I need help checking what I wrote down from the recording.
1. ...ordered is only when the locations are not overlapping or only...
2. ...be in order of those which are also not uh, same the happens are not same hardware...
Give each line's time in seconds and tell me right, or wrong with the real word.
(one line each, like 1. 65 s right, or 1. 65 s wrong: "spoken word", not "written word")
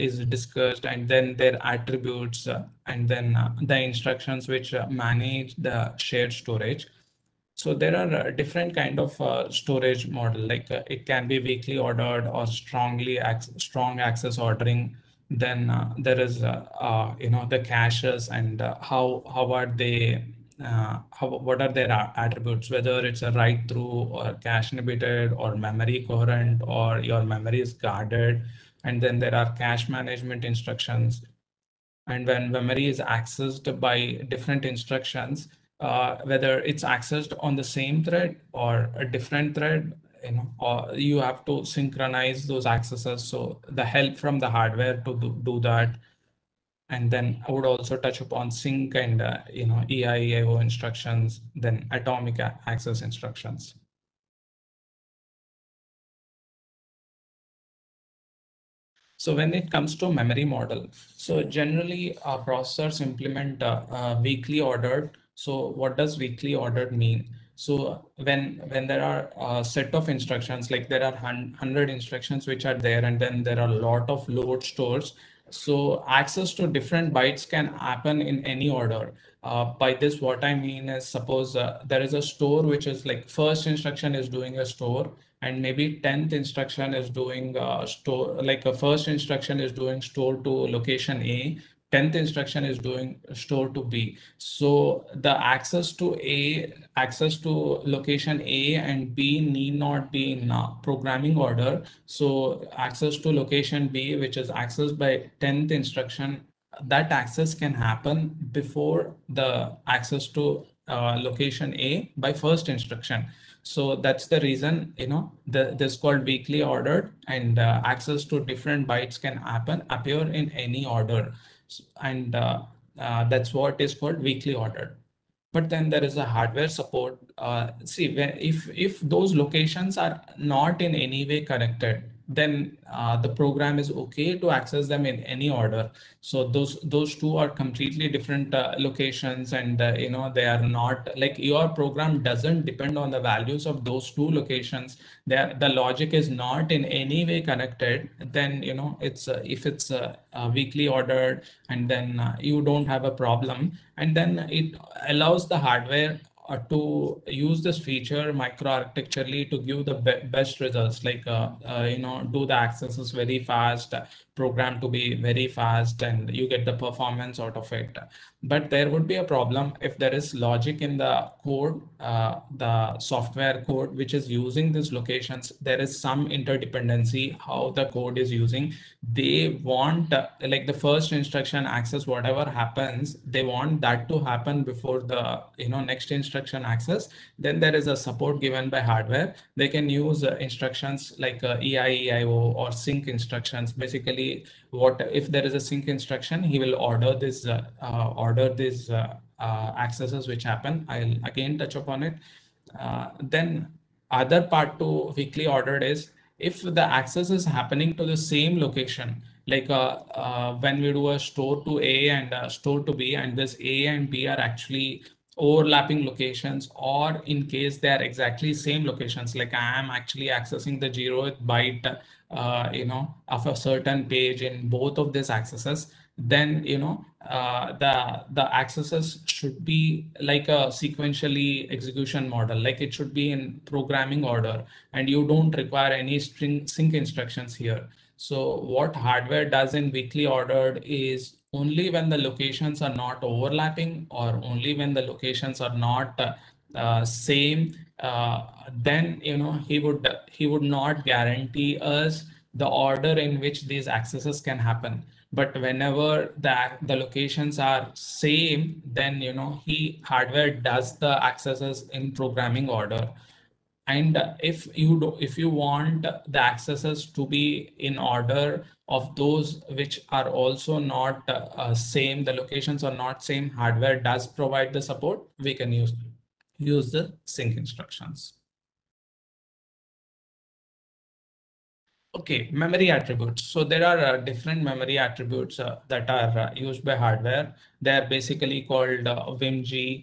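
1. 240 s right
2. 267 s wrong: "locations", not "happens".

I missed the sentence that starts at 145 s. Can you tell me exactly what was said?
There the logic is not in any way connected.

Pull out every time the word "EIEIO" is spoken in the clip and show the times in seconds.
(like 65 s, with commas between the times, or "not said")
49 s, 191 s.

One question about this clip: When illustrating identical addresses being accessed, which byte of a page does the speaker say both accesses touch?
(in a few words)
zeroth byte.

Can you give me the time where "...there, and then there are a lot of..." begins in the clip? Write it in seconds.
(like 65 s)
72 s.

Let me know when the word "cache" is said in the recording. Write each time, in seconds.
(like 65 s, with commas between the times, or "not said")
17 s, 24 s, 29 s.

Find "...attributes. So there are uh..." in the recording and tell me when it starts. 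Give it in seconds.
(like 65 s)
282 s.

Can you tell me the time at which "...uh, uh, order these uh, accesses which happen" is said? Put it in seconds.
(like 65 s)
197 s.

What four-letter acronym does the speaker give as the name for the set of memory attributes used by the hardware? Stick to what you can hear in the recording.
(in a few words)
WIMG.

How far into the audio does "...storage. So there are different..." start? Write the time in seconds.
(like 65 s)
6 s.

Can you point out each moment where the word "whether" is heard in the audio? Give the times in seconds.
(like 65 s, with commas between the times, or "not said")
22 s, 36 s.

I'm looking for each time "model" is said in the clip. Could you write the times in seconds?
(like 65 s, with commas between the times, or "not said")
10 s, 60 s, 232 s.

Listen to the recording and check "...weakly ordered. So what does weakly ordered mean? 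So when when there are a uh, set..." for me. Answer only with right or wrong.
right.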